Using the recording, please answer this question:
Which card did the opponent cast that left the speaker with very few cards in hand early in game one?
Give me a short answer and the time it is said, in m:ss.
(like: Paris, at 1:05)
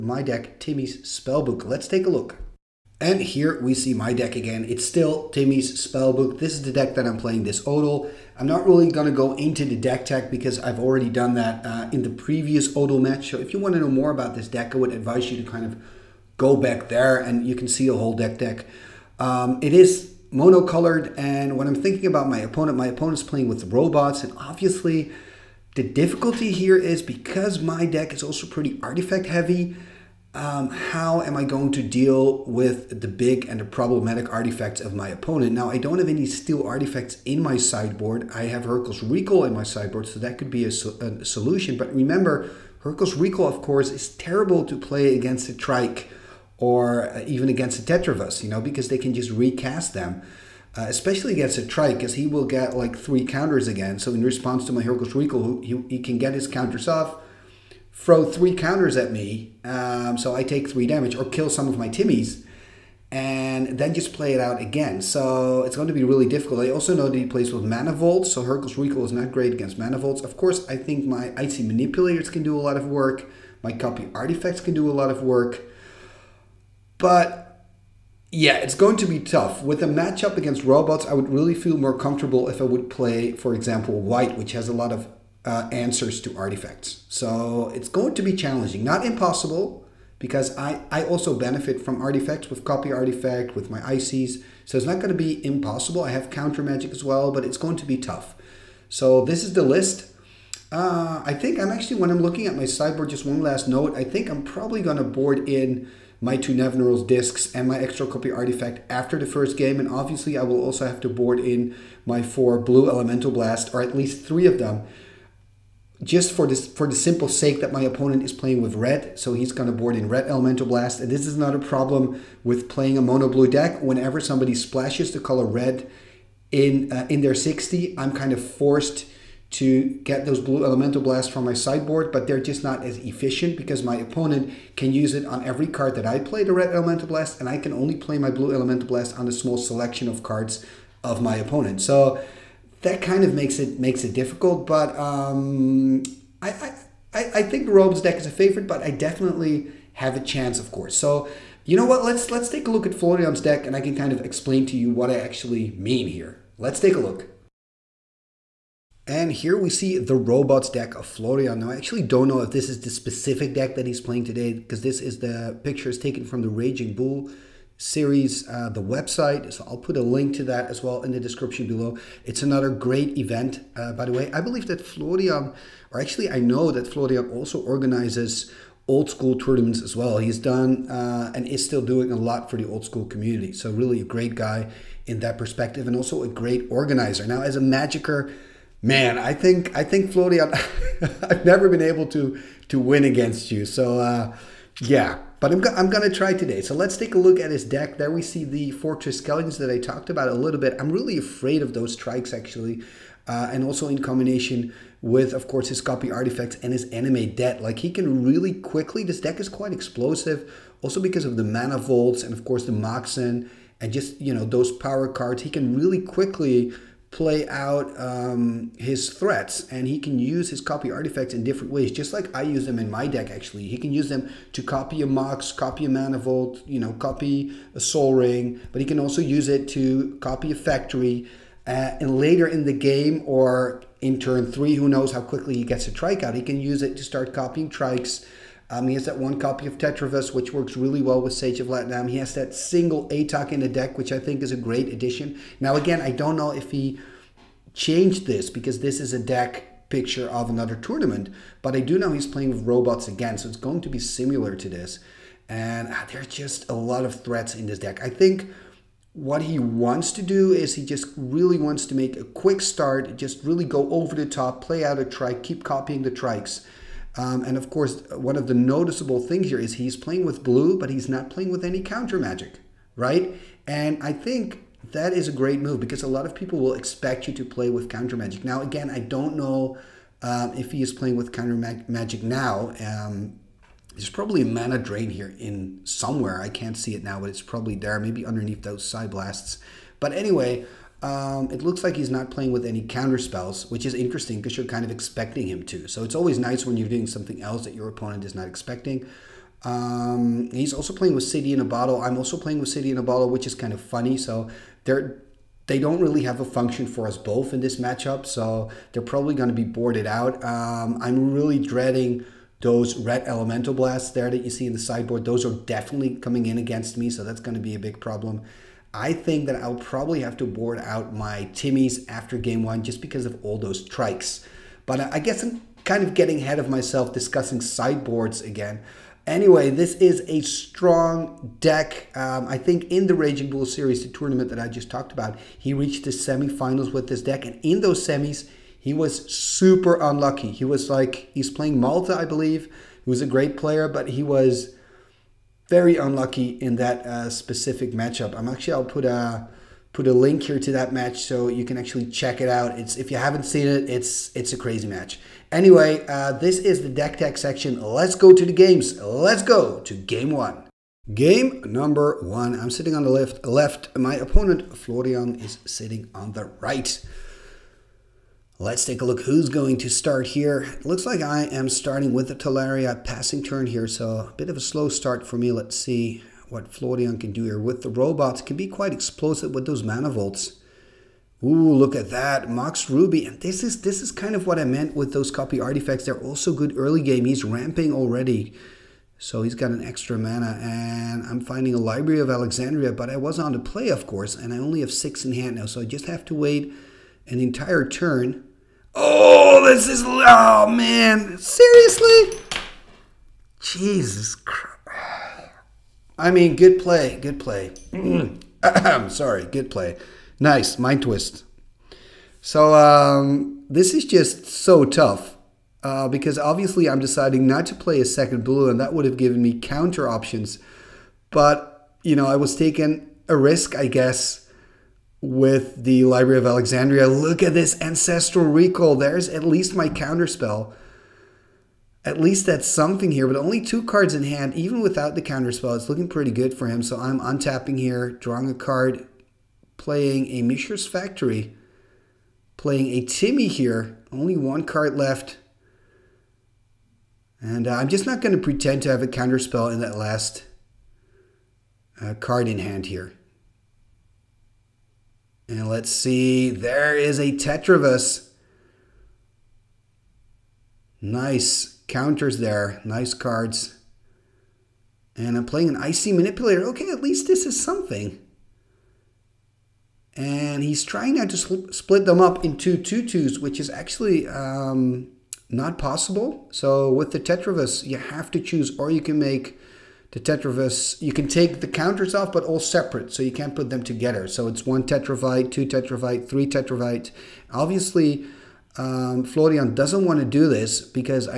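Mind Twist, at 6:50.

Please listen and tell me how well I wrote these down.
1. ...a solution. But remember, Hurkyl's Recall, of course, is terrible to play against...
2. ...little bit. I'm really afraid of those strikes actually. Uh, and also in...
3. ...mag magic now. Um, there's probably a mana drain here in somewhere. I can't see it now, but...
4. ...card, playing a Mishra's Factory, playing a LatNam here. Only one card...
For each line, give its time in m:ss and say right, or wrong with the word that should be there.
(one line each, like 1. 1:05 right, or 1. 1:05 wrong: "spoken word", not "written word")
1. 0:40 right
2. 3:20 right
3. 4:41 right
4. 7:18 wrong: "Timmy", not "LatNam".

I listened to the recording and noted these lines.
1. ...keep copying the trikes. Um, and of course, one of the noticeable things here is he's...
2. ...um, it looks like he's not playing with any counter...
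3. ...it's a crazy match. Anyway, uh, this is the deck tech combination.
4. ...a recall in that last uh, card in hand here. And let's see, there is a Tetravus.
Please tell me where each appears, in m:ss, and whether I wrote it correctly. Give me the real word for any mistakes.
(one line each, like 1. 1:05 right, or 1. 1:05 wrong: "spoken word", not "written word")
1. 4:25 right
2. 4:51 right
3. 5:54 wrong: "section", not "combination"
4. 7:29 wrong: "counterspell", not "recall".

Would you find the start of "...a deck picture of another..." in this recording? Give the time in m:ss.
4:09.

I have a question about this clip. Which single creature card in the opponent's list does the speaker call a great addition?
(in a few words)
Atog.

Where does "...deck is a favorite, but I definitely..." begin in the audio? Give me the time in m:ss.
2:28.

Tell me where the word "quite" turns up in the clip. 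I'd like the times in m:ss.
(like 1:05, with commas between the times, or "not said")
3:29, 6:18.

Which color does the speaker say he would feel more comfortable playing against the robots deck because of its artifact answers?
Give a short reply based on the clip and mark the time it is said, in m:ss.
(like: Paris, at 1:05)
White, at 1:23.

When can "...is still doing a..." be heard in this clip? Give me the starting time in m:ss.
3:01.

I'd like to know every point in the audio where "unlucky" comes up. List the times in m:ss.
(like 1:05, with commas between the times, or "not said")
5:39, 5:45.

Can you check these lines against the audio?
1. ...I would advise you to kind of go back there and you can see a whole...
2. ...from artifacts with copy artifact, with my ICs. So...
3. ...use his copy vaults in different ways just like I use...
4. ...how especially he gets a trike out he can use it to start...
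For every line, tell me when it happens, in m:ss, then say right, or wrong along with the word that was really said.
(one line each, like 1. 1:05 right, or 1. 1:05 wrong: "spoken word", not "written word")
1. 0:14 right
2. 1:31 right
3. 3:40 wrong: "artifacts", not "vaults"
4. 3:55 wrong: "quickly", not "especially".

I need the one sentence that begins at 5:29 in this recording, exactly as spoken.
Anyway, this is a strong deck.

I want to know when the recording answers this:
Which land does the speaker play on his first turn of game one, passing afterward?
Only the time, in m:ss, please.
6:12.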